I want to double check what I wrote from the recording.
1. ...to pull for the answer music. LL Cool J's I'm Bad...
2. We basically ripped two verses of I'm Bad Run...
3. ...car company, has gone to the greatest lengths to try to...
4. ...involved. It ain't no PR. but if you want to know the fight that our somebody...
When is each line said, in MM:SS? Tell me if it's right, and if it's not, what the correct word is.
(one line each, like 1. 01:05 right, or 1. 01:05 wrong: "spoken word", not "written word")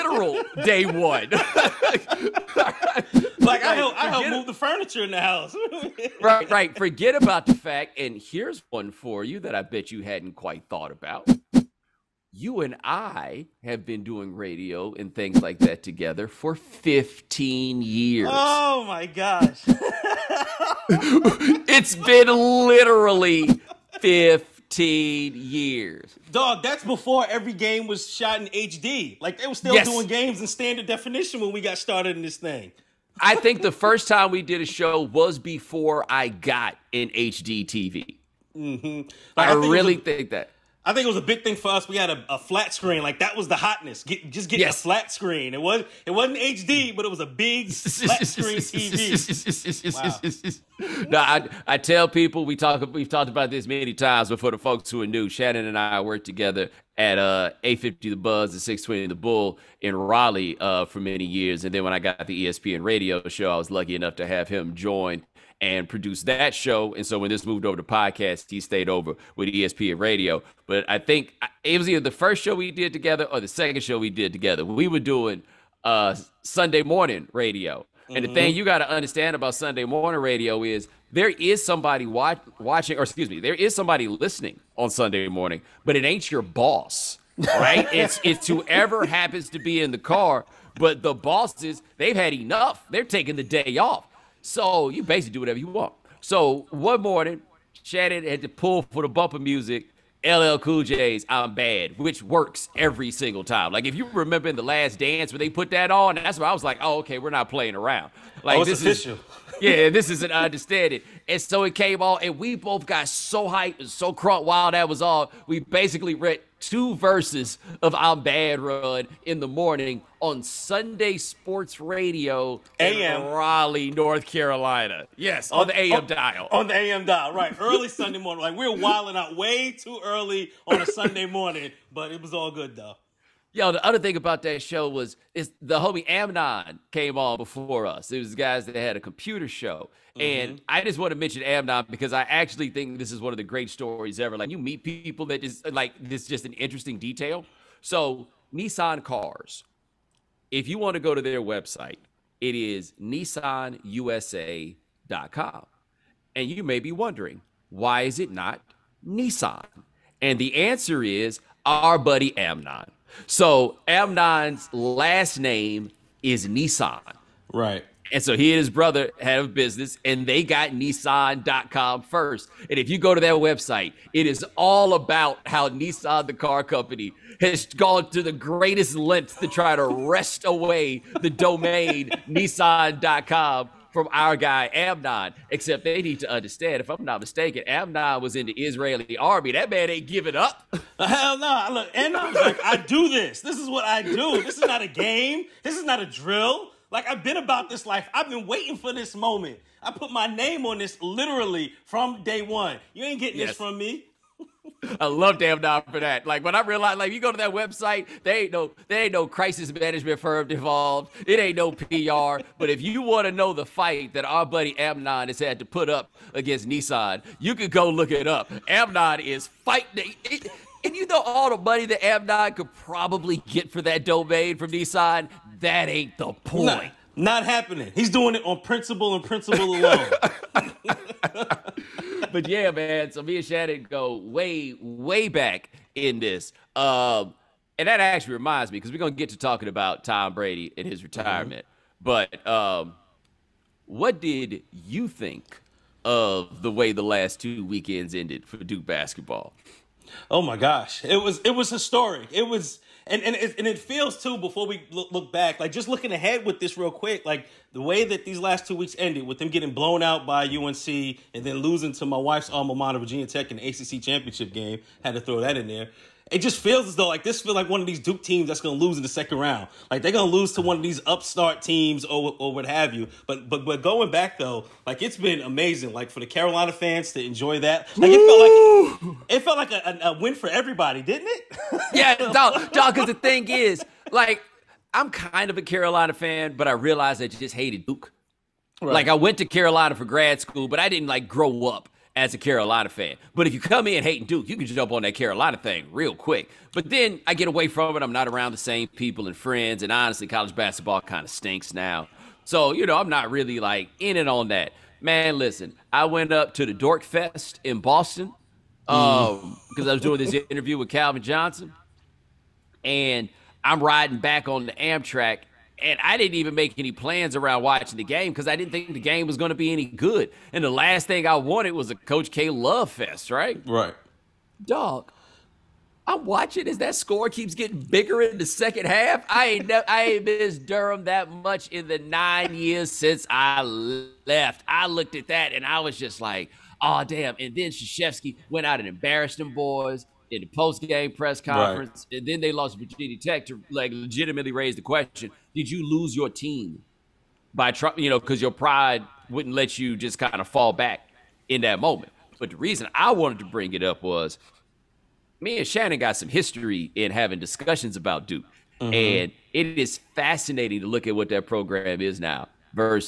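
1. 01:38 wrong: "bumper", not "answer"
2. 01:55 right
3. 02:56 right
4. 03:30 wrong: "buddy", not "somebody".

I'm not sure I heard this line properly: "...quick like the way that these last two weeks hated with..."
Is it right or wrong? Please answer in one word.
wrong.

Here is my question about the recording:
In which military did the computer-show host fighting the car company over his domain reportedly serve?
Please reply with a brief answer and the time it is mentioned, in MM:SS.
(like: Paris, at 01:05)
Israeli army, at 03:08.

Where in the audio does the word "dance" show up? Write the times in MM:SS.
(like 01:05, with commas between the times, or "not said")
01:44.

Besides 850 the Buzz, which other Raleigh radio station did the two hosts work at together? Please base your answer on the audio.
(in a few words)
620 the Bull.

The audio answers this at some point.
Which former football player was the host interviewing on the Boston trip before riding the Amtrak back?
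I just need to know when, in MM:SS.
05:10.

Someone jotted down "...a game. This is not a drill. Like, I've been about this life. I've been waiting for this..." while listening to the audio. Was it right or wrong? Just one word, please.
right.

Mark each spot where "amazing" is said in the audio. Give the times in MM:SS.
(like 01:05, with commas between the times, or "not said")
04:35.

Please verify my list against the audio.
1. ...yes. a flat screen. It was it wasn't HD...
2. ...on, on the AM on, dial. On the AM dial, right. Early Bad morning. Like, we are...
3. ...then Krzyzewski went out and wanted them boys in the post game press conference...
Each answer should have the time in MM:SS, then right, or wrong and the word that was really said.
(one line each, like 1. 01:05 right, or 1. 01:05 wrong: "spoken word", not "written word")
1. 00:44 right
2. 02:05 wrong: "Sunday", not "Bad"
3. 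05:37 wrong: "embarrassed", not "wanted".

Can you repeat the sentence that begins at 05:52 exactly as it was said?
But the reason I wanted to bring it up was me and Shannon got some history in having discussions about Duke.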